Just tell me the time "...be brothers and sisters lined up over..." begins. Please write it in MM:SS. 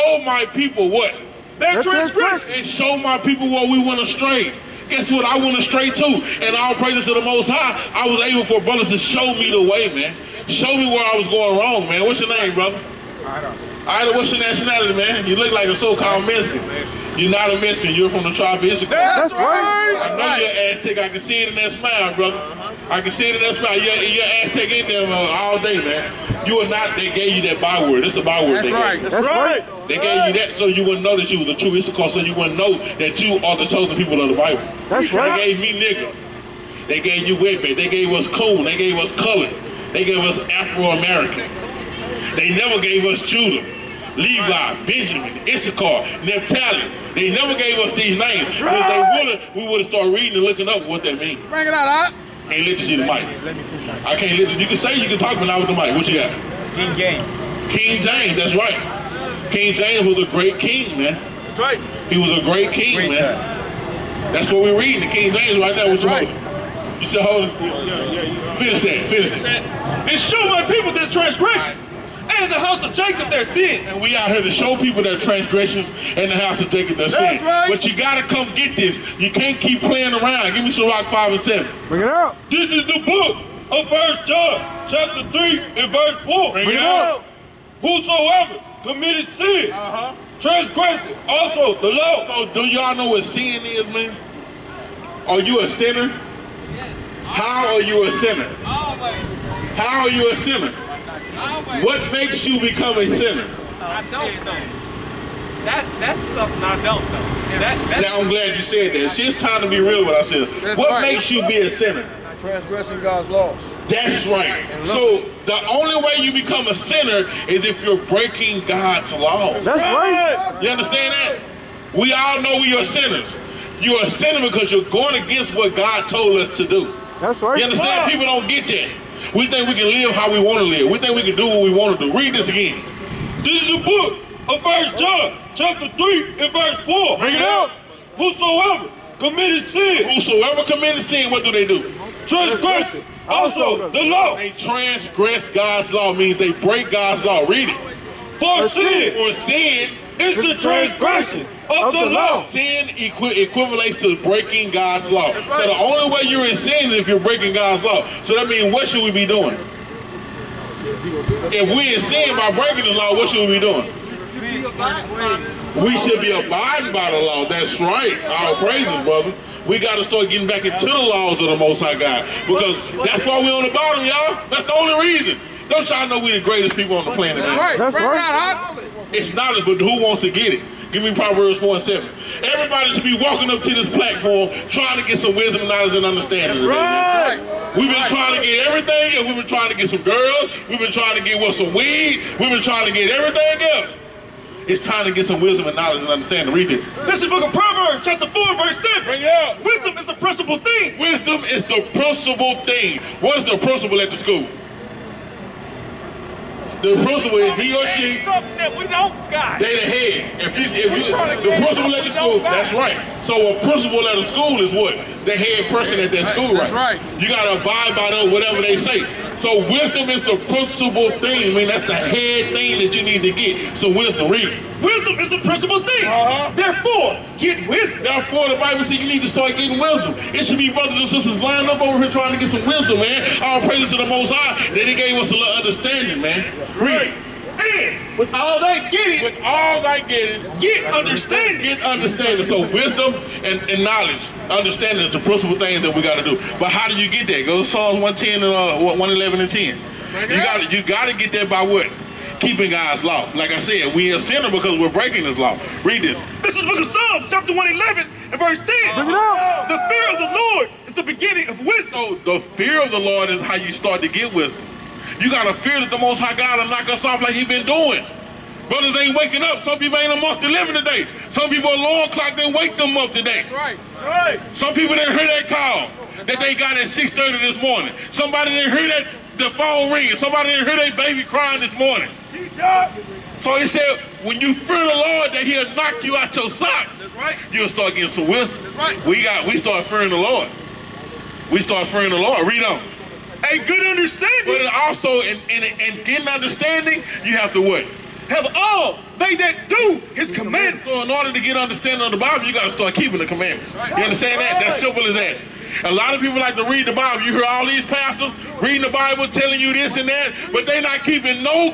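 03:50.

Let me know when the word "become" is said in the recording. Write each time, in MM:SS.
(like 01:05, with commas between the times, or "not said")
01:42, 01:56.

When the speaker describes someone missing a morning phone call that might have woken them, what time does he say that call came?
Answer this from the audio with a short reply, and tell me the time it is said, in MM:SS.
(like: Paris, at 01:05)
6:30, at 04:36.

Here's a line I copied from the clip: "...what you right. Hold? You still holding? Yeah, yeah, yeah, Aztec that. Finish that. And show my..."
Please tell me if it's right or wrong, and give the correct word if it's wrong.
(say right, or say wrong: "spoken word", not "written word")
wrong: "Finish", not "Aztec".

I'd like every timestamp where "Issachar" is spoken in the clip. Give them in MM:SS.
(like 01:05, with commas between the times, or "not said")
00:31, 00:45.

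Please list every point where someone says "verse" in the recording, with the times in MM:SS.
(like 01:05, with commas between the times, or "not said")
01:25, 02:16, 03:18, 04:18.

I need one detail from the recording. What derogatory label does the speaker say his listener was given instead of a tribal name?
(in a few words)
whippy.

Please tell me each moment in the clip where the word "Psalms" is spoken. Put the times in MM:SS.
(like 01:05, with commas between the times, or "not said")
04:07, 04:16.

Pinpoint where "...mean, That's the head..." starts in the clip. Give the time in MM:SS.
03:41.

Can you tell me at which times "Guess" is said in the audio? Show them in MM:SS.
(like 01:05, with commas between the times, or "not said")
00:04.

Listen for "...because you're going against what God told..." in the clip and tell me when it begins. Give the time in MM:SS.
02:04.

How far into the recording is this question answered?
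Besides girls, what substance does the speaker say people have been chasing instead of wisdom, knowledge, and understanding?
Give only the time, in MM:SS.
03:11.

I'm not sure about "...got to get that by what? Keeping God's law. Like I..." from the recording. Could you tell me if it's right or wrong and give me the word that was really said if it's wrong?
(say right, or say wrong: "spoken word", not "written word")
right.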